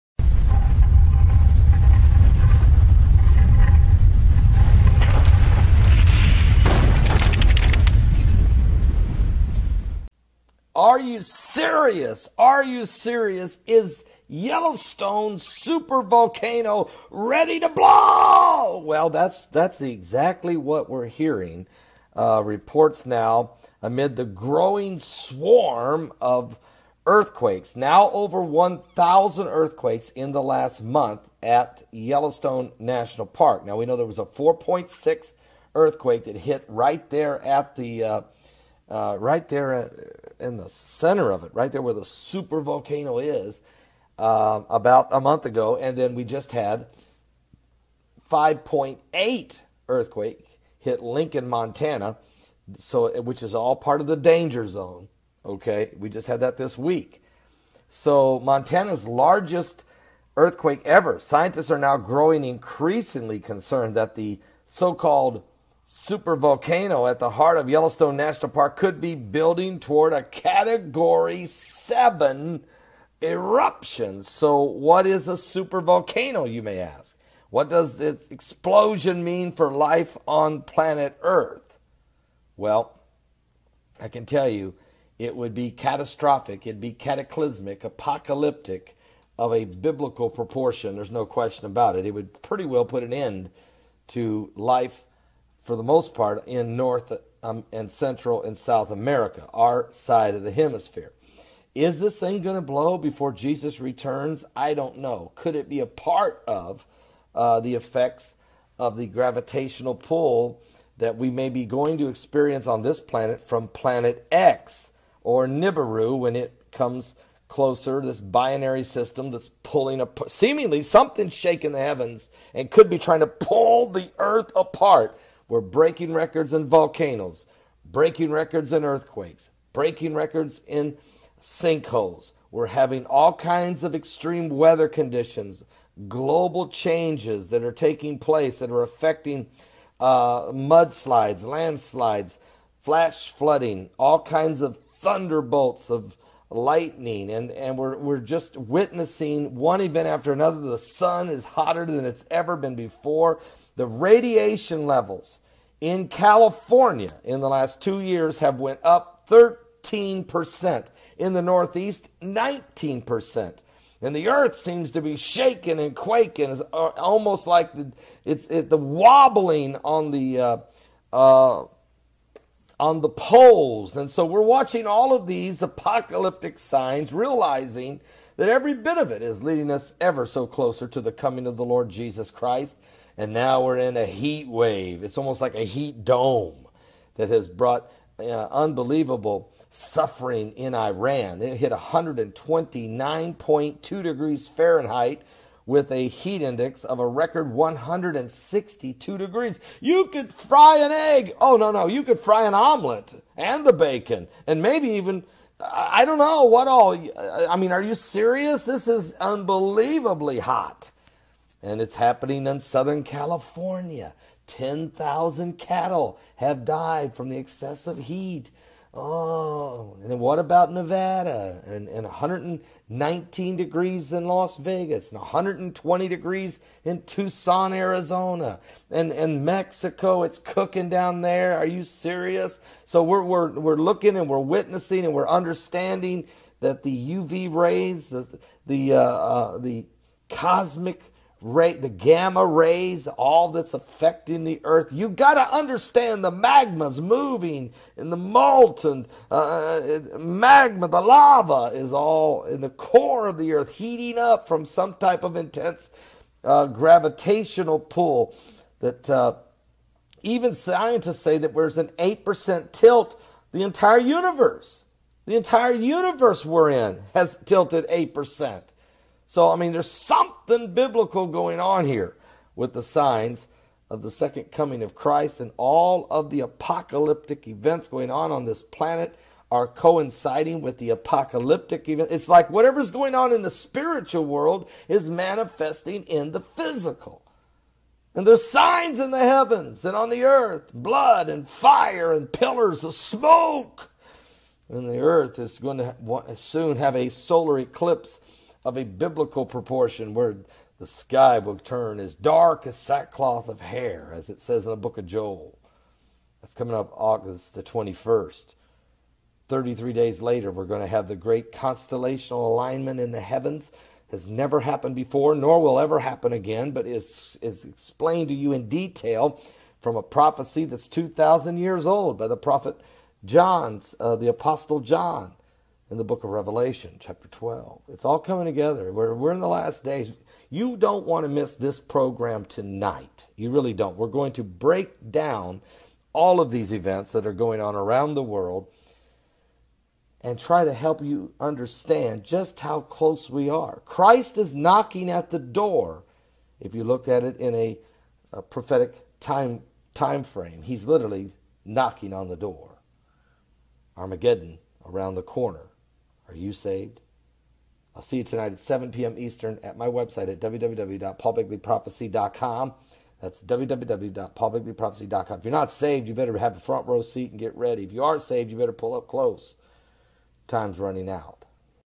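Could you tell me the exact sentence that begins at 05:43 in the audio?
Christ is knocking at the door.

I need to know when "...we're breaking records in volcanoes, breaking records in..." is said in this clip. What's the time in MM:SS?
02:05.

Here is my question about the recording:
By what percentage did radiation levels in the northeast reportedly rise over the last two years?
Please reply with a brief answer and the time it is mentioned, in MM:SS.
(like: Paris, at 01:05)
19%, at 02:42.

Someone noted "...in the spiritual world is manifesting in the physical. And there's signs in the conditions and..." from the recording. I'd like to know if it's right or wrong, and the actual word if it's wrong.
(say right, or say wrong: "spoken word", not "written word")
wrong: "heavens", not "conditions".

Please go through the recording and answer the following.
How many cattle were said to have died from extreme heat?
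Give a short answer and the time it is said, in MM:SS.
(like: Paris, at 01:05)
10,000, at 03:34.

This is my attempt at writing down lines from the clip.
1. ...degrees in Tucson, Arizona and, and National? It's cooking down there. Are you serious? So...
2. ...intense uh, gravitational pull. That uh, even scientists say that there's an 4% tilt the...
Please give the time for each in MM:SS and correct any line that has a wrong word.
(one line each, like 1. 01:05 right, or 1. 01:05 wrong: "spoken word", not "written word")
1. 03:46 wrong: "Mexico", not "National"
2. 04:15 wrong: "8", not "4".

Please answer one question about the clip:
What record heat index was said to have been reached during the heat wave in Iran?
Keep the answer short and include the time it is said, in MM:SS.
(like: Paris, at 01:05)
162 degrees, at 03:17.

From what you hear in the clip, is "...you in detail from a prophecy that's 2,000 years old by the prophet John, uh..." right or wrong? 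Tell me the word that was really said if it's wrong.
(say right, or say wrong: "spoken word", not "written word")
right.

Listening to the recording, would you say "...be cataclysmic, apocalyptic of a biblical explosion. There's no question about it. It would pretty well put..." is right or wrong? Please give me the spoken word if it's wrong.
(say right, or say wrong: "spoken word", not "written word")
wrong: "proportion", not "explosion".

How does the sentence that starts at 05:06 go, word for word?
That's coming up August the 21st.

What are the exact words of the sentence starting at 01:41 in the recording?
Is this thing going to blow before Jesus returns?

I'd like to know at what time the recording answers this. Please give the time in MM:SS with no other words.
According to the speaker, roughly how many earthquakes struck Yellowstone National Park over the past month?
00:28.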